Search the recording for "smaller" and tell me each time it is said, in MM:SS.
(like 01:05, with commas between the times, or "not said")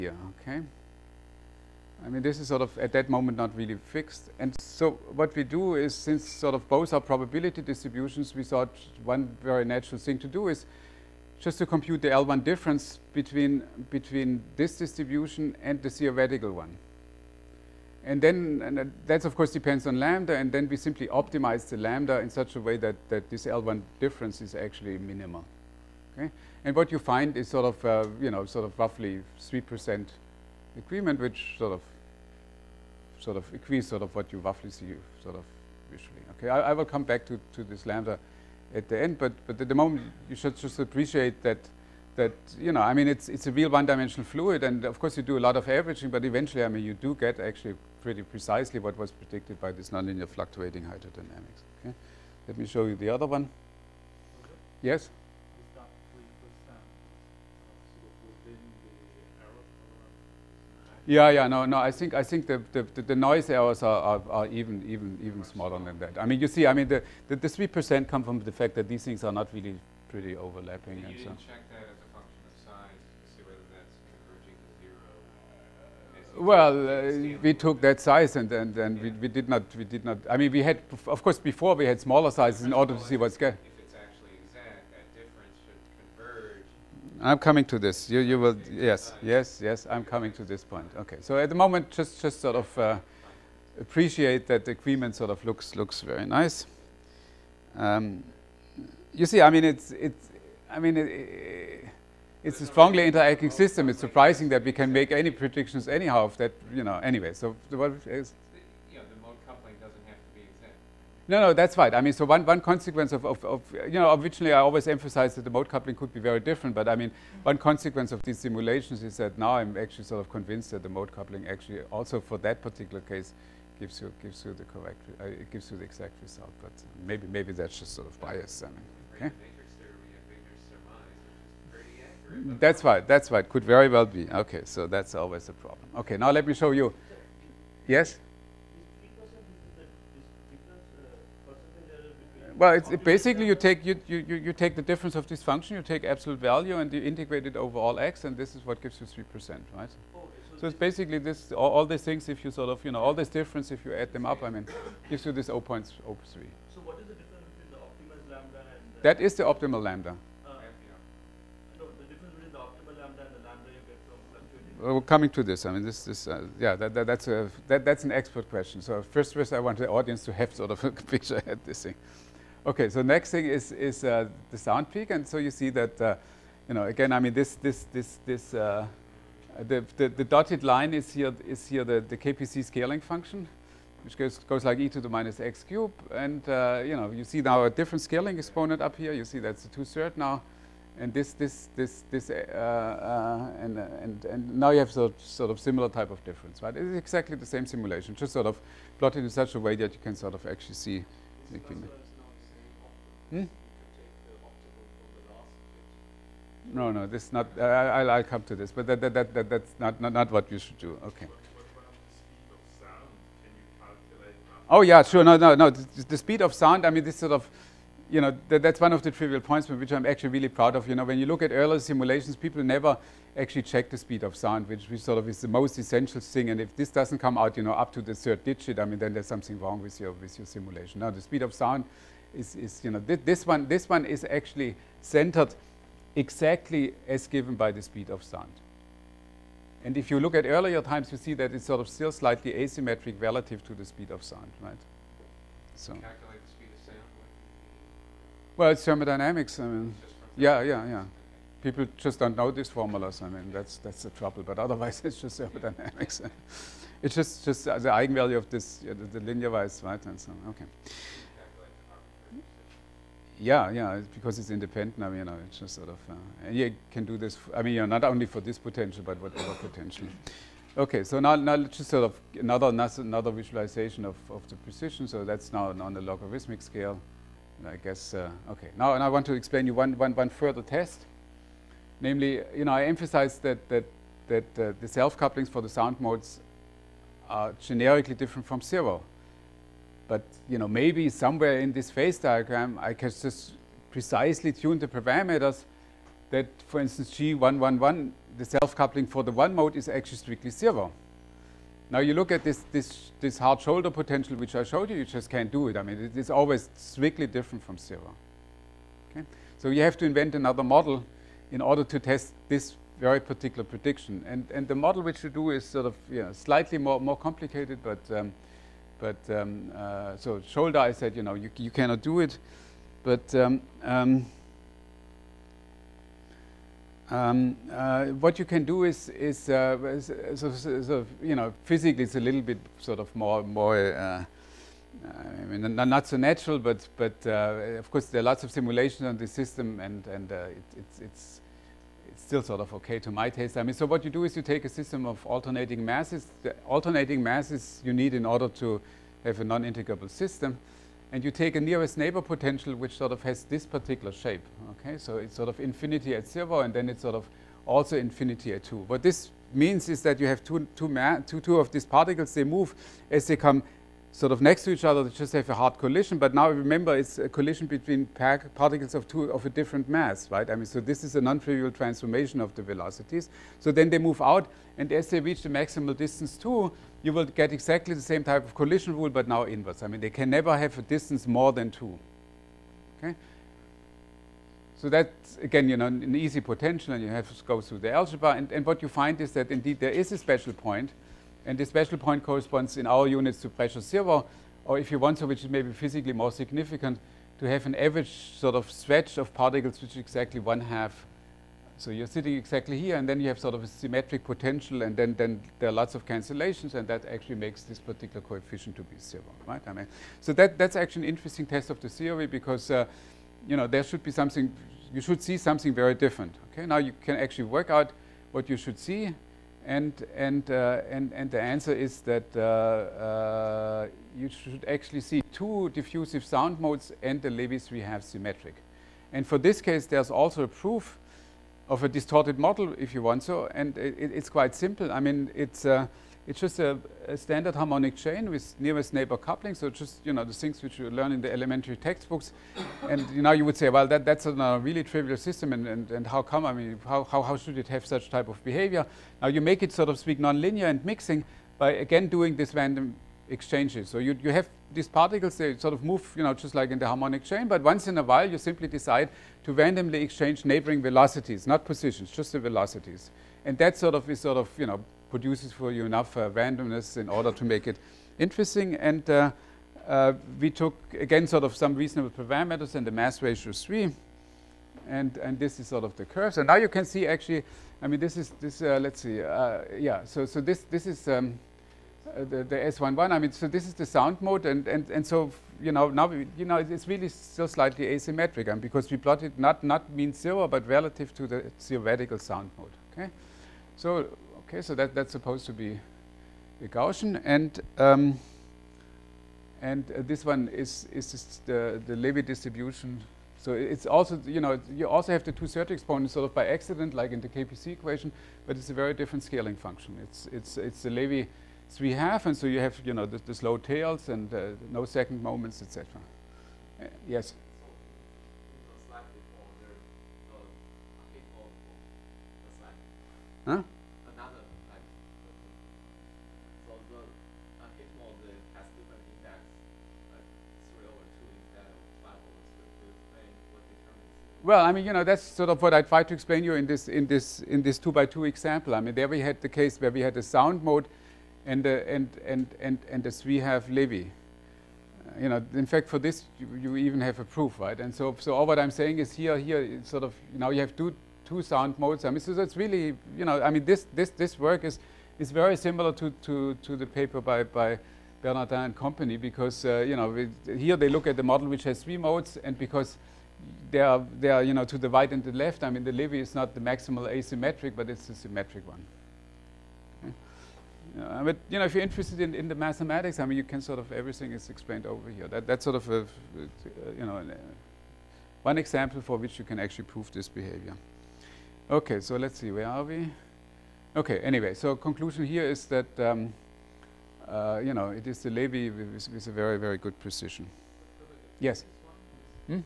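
01:05, 01:22.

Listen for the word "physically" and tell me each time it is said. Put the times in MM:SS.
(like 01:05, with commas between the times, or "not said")
05:31, 06:35.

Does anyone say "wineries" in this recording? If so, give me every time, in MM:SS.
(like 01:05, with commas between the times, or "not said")
not said.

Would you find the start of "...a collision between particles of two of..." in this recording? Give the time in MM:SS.
06:07.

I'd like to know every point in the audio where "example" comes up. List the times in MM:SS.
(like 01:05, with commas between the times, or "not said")
08:58, 09:38.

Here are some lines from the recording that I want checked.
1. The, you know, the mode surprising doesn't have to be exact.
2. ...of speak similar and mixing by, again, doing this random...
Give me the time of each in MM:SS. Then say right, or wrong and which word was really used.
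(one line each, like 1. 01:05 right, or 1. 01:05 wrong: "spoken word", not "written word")
1. 01:48 wrong: "coupling", not "surprising"
2. 07:29 wrong: "nonlinear", not "similar".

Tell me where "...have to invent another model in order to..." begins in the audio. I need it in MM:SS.
05:09.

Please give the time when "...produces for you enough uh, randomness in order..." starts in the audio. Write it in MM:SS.
07:45.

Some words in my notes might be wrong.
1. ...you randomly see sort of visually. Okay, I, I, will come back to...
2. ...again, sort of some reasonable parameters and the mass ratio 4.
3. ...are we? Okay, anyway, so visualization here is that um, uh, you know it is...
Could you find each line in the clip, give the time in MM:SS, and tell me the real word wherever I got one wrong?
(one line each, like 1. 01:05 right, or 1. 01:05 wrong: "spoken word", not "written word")
1. 00:34 wrong: "roughly", not "randomly"
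2. 07:50 wrong: "3", not "4"
3. 09:42 wrong: "conclusion", not "visualization".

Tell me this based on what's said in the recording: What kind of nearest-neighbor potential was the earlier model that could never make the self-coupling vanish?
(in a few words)
hard shoulder potential.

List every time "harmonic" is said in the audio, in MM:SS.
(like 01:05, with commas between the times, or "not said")
07:17, 07:36.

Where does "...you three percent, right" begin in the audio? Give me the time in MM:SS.
02:29.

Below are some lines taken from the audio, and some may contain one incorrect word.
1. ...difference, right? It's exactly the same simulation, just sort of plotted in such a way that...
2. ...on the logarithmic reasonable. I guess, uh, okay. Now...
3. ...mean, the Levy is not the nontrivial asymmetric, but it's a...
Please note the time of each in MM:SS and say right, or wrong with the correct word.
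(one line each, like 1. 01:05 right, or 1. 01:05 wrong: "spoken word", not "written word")
1. 03:16 right
2. 04:35 wrong: "scale", not "reasonable"
3. 09:25 wrong: "maximal", not "nontrivial".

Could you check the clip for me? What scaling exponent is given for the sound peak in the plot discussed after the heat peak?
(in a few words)
two third.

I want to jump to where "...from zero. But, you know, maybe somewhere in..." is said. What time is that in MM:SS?
04:48.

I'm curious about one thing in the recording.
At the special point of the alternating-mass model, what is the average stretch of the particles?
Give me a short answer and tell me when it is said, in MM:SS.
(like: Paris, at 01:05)
one half, at 06:40.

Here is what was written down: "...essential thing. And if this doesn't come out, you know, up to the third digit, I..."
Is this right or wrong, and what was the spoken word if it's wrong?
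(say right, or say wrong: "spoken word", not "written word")
right.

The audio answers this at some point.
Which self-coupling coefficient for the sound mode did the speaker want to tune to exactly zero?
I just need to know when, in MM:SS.
04:57.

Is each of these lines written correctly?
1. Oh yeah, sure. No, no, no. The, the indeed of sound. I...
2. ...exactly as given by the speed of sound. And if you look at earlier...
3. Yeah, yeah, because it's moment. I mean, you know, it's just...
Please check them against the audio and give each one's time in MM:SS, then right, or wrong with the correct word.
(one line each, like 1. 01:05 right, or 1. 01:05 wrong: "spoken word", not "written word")
1. 03:34 wrong: "speed", not "indeed"
2. 03:56 right
3. 04:23 wrong: "independent", not "moment".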